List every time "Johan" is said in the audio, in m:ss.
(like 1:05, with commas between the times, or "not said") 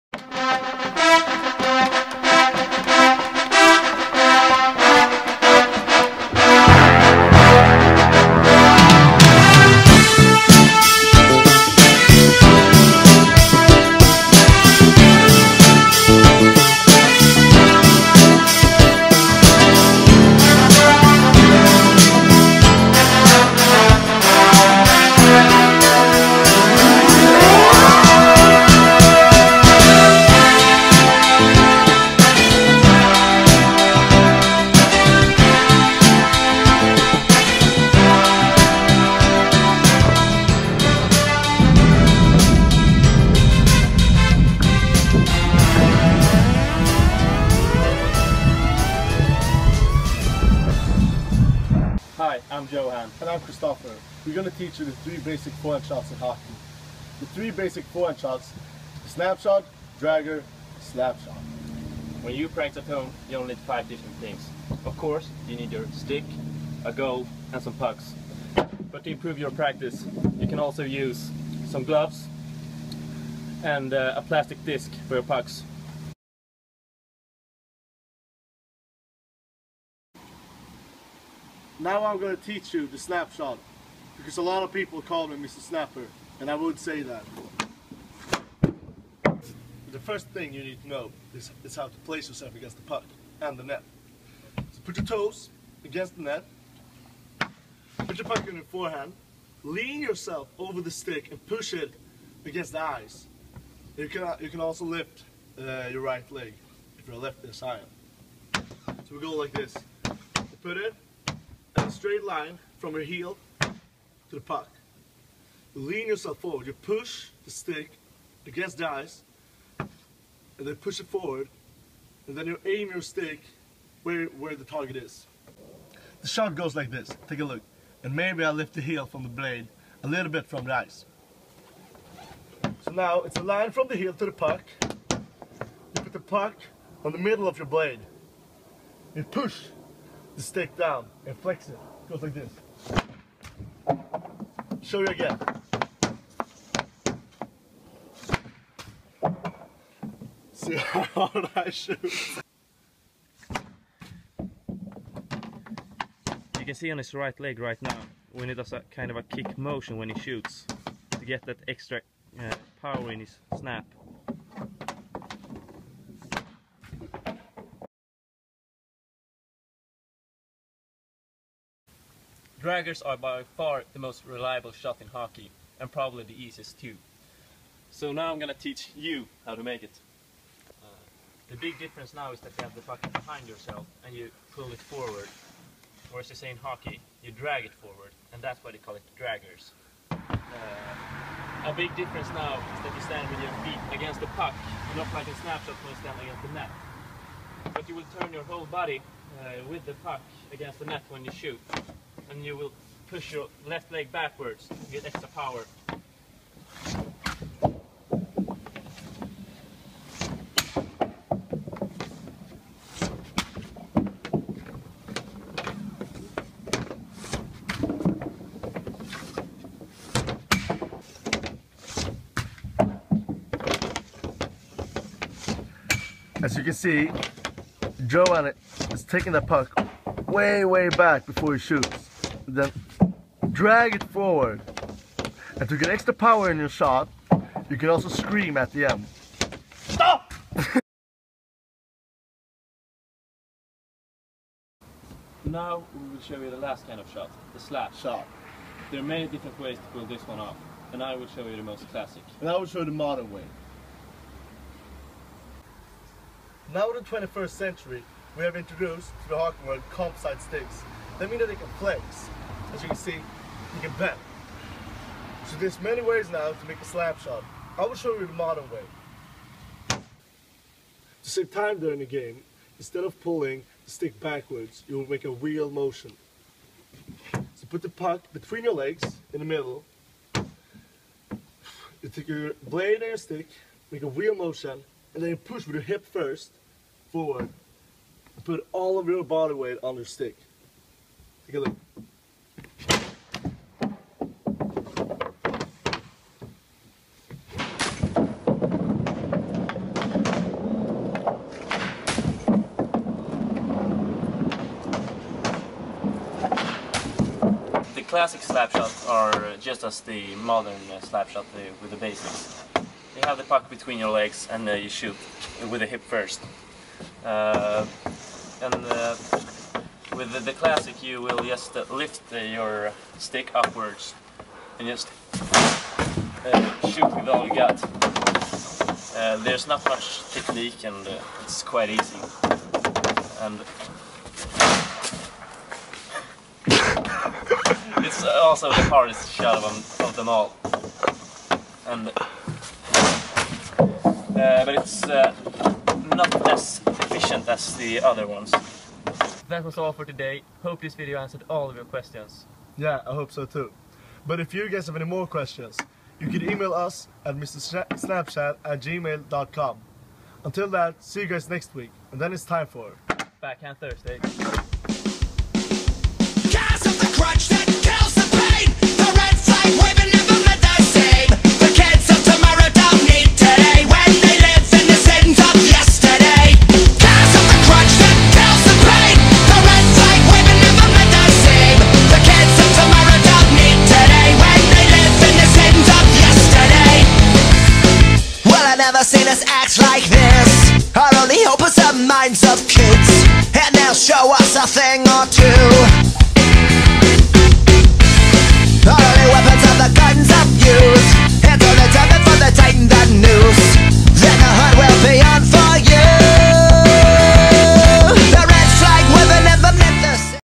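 0:52, 3:48.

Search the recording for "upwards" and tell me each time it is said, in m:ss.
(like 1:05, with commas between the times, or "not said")
5:23.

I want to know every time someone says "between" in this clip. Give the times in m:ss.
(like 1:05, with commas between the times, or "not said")
4:38, 5:13.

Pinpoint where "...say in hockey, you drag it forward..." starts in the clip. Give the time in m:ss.
3:06.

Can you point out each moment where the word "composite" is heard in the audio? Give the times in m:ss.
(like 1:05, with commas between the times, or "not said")
4:19.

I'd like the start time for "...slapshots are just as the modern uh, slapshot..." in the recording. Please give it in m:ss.
5:08.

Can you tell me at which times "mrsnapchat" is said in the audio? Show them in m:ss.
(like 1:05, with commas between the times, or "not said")
5:57.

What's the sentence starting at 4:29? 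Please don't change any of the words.
To save time during the game, instead of pulling the stick backwards, you will make a wheel motion.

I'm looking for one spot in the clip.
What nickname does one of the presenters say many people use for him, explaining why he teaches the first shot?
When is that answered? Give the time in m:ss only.
1:25.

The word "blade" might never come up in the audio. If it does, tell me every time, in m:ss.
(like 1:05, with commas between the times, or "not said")
2:09, 2:17, 4:42.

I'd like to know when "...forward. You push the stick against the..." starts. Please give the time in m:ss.
1:56.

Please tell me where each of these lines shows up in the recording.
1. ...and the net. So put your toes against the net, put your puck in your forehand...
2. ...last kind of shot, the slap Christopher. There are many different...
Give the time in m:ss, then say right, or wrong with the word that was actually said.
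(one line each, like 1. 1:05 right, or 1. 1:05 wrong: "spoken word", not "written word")
1. 1:33 right
2. 4:06 wrong: "Shot", not "Christopher".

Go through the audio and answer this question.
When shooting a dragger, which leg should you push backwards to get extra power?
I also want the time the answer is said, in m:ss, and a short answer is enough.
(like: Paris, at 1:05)
left leg, at 3:23.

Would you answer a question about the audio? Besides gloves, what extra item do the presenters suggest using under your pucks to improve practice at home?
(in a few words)
a plastic disc.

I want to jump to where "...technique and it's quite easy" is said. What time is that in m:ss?
5:30.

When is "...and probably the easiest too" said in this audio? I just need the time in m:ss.
2:55.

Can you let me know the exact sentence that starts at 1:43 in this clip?
You can, you can also lift uh, your right leg if you're left this high.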